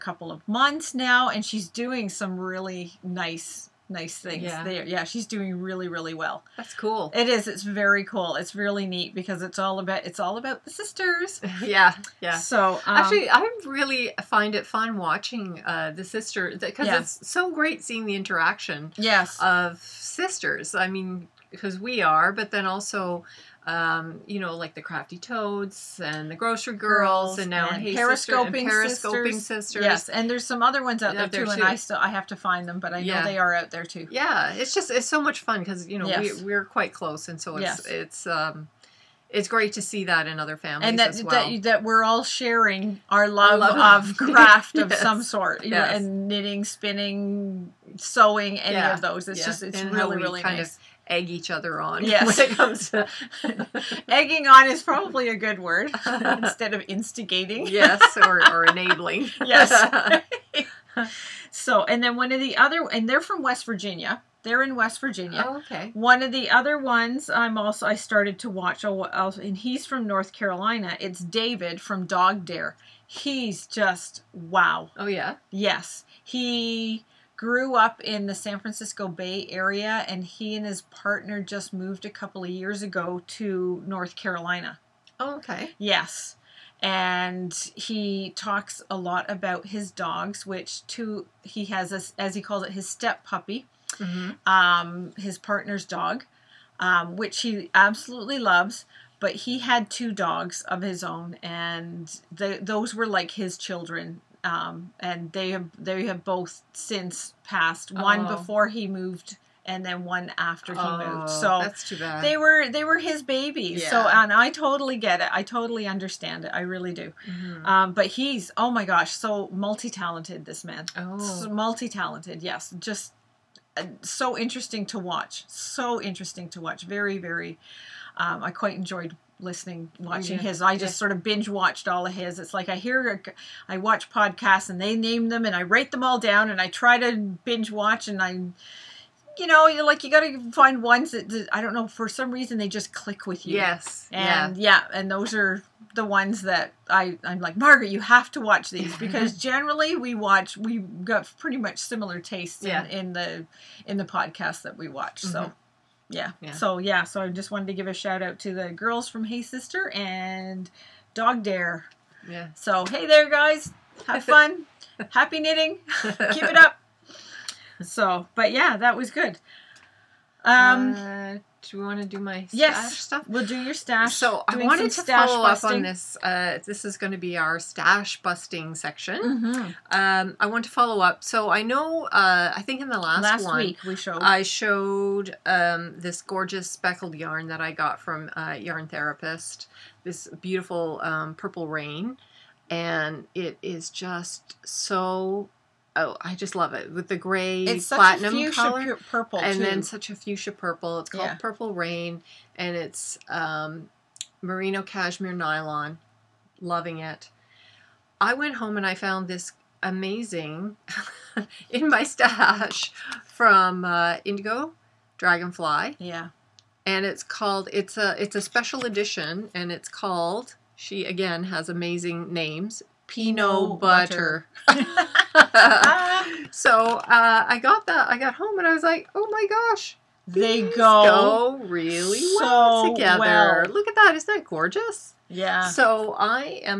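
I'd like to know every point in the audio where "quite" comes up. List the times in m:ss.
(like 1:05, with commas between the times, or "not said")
0:36, 2:08.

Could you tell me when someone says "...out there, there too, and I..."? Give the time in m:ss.
0:31.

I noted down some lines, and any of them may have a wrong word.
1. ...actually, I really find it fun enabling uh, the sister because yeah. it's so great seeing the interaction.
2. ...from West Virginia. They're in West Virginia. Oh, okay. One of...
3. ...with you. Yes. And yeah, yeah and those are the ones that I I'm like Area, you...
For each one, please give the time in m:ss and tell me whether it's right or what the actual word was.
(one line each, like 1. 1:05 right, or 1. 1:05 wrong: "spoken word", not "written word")
1. 0:12 wrong: "watching", not "enabling"
2. 1:03 right
3. 2:23 wrong: "Margaret", not "Area".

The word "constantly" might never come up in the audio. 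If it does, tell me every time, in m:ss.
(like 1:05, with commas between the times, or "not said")
not said.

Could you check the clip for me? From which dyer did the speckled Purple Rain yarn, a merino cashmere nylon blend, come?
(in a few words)
Yarn Therapist.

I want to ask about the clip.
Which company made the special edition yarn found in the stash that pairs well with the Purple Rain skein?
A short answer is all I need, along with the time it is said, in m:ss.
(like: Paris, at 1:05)
Indigo Dragonfly, at 3:34.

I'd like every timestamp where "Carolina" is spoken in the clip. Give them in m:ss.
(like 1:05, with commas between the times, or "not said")
1:10, 1:24.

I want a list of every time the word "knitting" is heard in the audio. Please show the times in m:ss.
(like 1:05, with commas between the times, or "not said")
0:46, 2:45.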